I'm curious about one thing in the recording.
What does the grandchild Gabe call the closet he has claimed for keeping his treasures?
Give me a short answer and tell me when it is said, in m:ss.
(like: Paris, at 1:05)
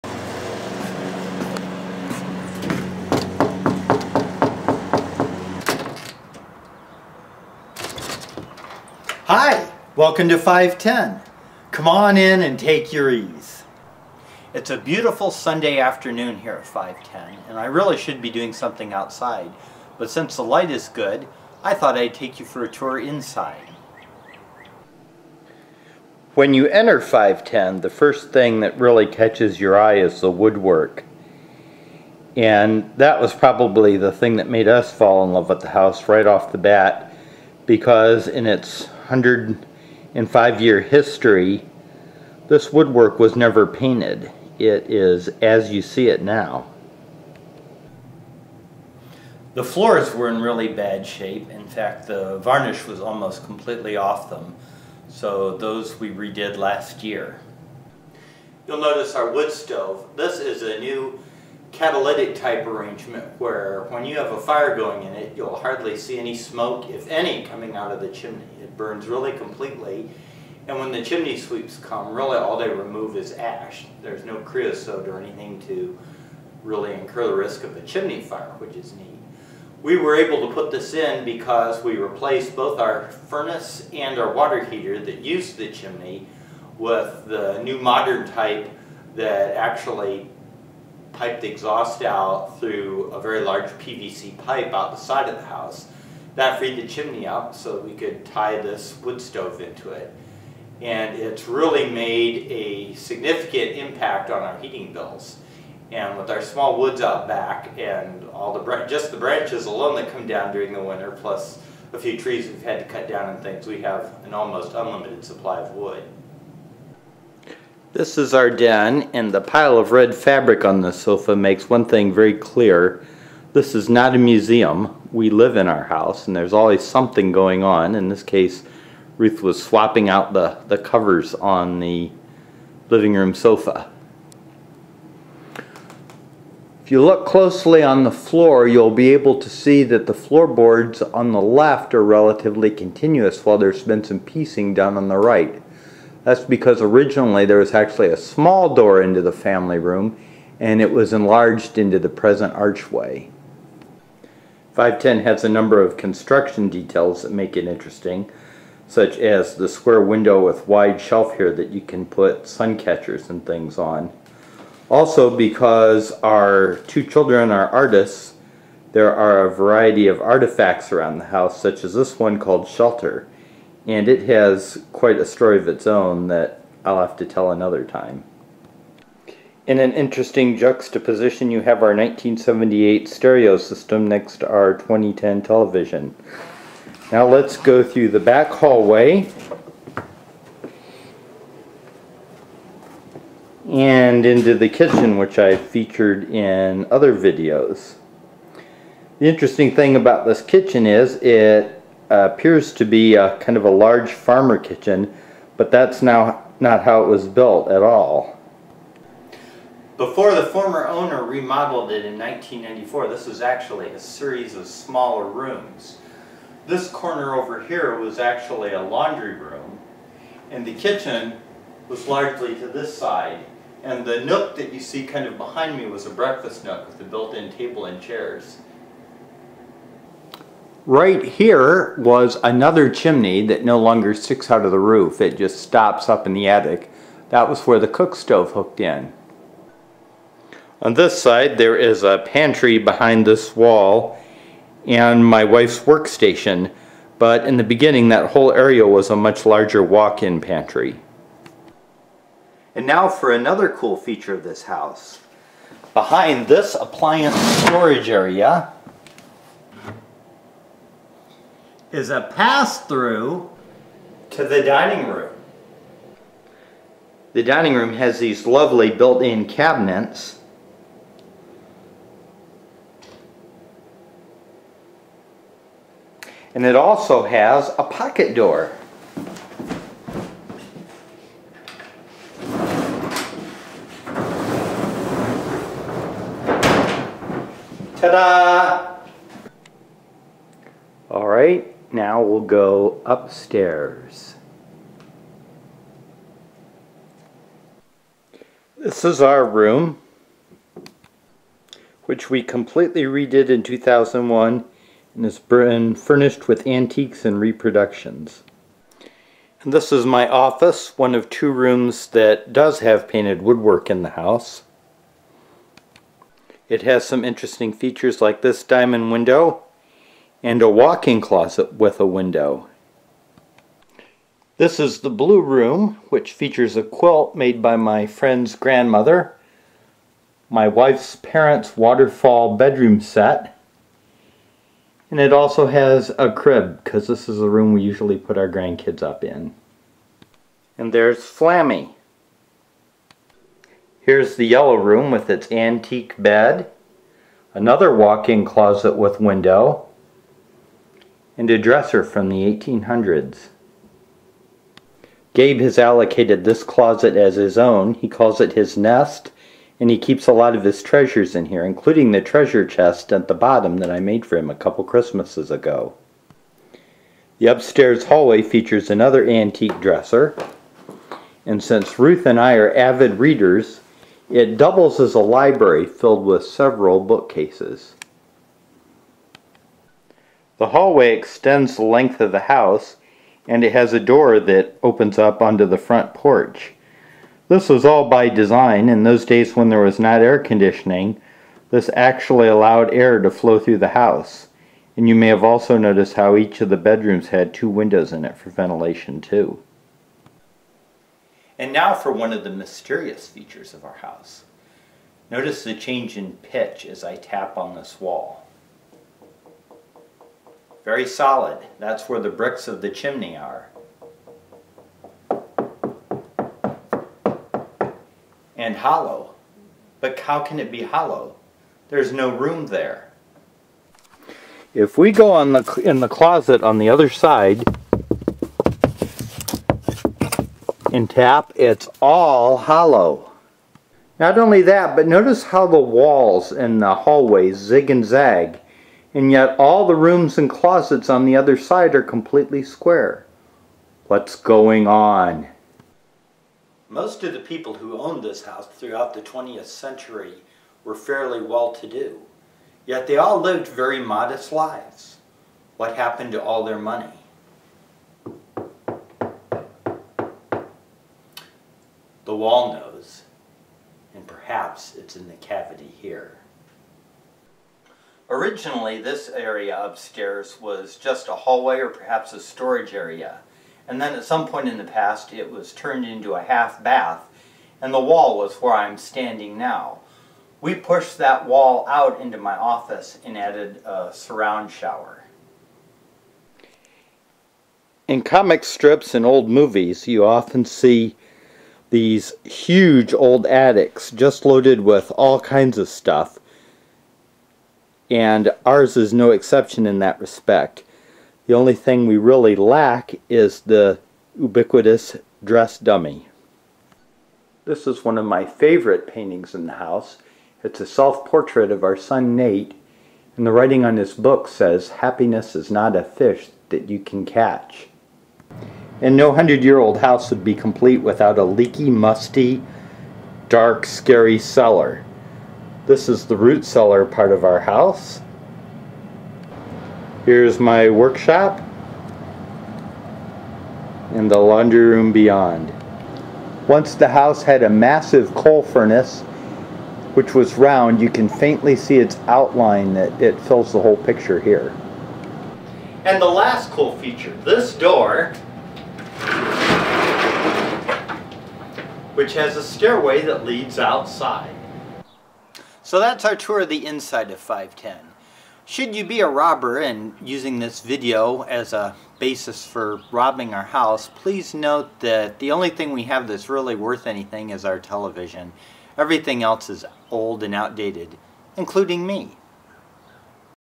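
his nest, at 5:58.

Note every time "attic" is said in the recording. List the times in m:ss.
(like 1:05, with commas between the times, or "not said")
3:56, 8:13.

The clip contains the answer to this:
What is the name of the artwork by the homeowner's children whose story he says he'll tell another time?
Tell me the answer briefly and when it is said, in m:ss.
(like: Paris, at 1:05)
Shelter, at 2:52.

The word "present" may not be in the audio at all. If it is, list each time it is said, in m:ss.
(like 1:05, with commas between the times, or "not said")
2:32.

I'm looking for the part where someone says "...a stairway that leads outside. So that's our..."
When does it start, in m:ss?
9:12.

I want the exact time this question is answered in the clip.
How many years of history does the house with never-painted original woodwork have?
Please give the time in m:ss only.
0:39.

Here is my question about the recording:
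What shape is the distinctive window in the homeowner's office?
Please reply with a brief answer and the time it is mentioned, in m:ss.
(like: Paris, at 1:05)
diamond, at 5:18.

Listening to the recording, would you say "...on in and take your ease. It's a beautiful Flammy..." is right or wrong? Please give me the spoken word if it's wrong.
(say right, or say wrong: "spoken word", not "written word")
wrong: "Sunday", not "Flammy".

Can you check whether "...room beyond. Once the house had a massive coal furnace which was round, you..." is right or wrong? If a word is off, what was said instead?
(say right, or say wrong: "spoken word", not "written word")
right.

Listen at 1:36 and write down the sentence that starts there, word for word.
That freed the chimney up so we could tie this wood stove into it.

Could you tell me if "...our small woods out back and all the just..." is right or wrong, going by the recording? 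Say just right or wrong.
right.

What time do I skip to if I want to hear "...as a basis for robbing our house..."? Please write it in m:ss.
9:21.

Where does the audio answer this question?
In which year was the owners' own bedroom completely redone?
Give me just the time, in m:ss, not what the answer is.
5:03.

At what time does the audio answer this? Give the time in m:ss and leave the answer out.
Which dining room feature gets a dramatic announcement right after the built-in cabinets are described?
4:37.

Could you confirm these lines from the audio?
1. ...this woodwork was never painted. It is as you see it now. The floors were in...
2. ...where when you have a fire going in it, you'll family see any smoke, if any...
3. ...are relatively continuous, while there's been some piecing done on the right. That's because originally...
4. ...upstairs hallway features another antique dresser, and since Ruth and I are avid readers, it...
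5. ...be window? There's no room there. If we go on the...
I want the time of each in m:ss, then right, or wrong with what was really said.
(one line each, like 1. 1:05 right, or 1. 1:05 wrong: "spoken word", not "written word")
1. 0:42 right
2. 1:03 wrong: "hardly", not "family"
3. 2:21 right
4. 6:07 right
5. 7:00 wrong: "hollow", not "window".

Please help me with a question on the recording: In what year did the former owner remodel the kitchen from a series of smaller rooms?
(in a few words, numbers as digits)
1994.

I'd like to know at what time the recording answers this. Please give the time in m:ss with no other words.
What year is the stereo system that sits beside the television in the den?
3:01.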